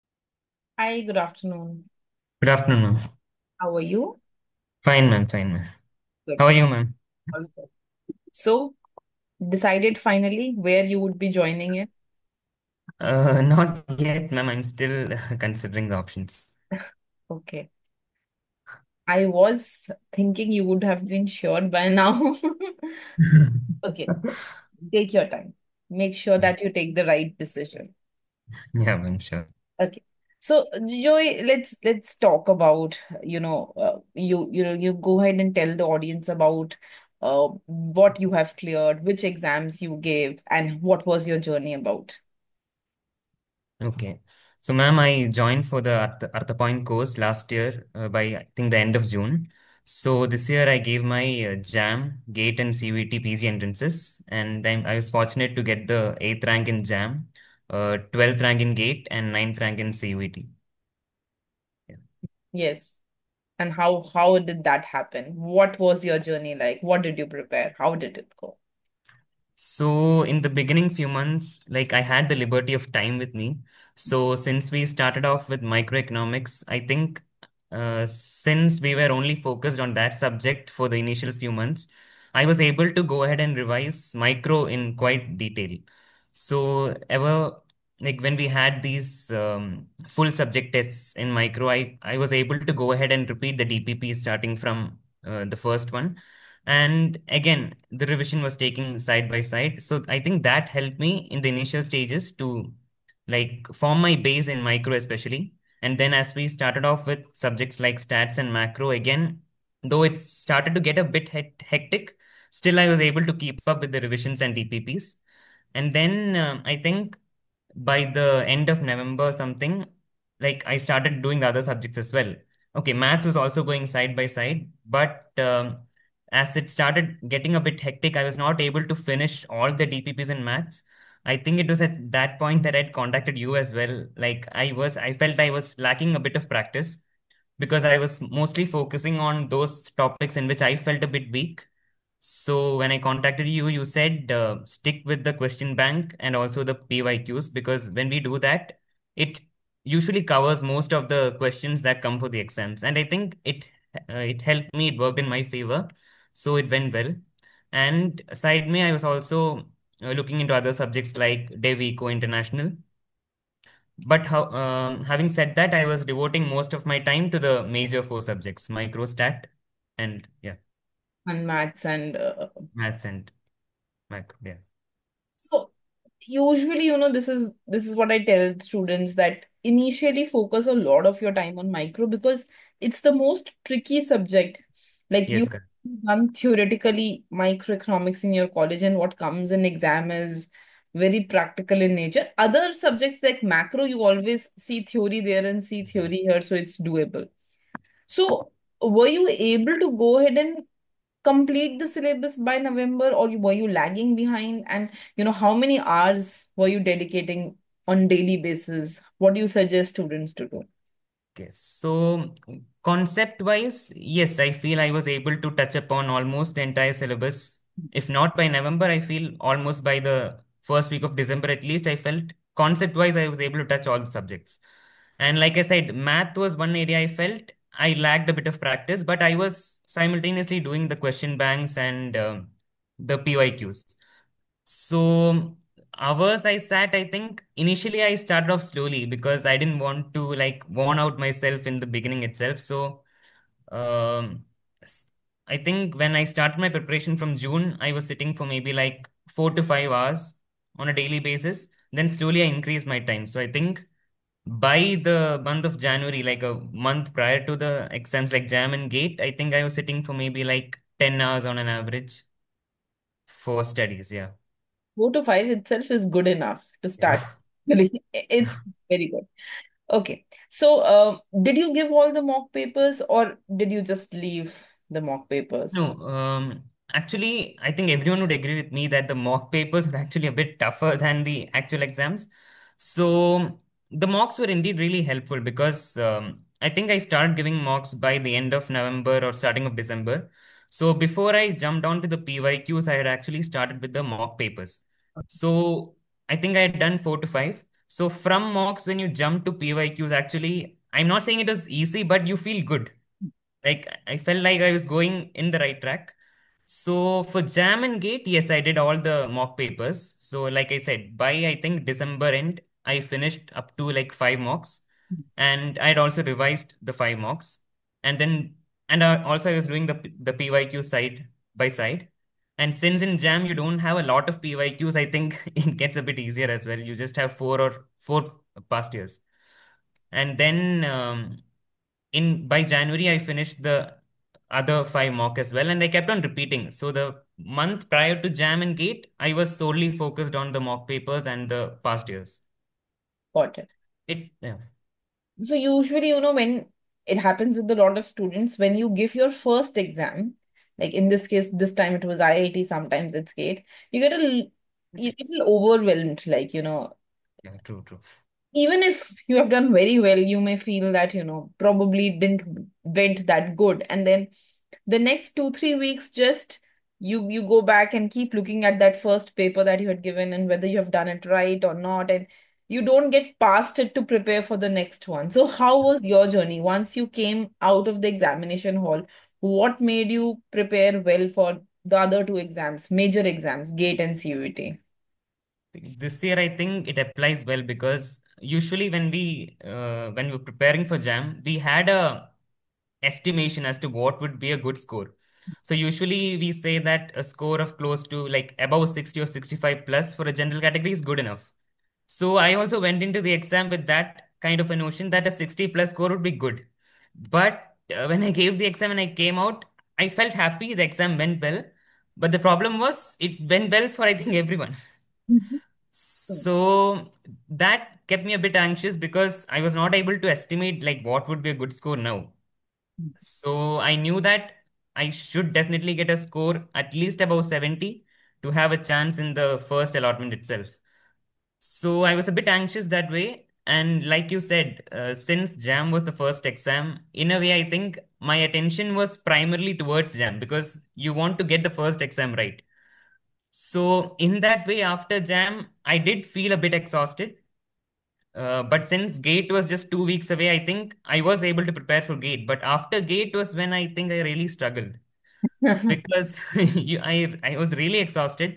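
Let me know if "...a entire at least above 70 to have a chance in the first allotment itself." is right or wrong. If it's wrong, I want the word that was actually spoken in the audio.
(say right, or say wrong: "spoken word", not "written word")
wrong: "score", not "entire".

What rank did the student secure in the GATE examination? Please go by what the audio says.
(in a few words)
12th.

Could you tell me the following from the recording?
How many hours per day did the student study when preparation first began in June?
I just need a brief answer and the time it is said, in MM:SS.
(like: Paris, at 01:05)
4 to 5 hours, at 04:09.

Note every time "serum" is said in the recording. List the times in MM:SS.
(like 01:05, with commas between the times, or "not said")
not said.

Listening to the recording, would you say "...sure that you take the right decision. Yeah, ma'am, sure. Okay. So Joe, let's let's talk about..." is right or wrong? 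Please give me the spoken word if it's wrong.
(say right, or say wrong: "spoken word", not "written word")
right.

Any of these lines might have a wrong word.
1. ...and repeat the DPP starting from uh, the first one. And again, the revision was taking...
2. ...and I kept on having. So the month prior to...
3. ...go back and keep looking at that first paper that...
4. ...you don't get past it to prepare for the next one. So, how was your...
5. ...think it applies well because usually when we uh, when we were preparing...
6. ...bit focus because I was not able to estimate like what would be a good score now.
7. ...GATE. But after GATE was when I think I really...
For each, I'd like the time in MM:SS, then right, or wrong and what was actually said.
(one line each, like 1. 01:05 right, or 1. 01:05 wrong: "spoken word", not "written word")
1. 01:33 right
2. 05:35 wrong: "repeating", not "having"
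3. 06:07 right
4. 06:12 right
5. 06:26 right
6. 06:58 wrong: "anxious", not "focus"
7. 07:32 right.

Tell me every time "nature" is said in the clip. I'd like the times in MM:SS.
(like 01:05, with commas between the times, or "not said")
03:11.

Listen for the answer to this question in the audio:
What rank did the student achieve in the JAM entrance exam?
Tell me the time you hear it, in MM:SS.
00:56.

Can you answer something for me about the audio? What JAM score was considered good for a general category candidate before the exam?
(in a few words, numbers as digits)
60 or 65 plus.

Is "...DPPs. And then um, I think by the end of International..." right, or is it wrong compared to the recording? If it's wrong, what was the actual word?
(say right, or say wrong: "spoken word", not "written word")
wrong: "November", not "International".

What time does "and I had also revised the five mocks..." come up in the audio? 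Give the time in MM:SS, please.
05:15.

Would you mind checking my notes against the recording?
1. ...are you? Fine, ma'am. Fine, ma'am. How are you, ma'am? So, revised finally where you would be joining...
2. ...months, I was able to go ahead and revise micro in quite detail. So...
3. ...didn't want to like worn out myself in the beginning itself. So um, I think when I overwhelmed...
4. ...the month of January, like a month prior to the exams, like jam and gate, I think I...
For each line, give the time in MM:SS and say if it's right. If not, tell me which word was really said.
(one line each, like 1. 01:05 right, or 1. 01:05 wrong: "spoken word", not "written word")
1. 00:03 wrong: "decided", not "revised"
2. 01:21 right
3. 03:59 wrong: "started", not "overwhelmed"
4. 04:15 right.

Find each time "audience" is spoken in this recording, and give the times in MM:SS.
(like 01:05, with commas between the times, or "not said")
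00:35.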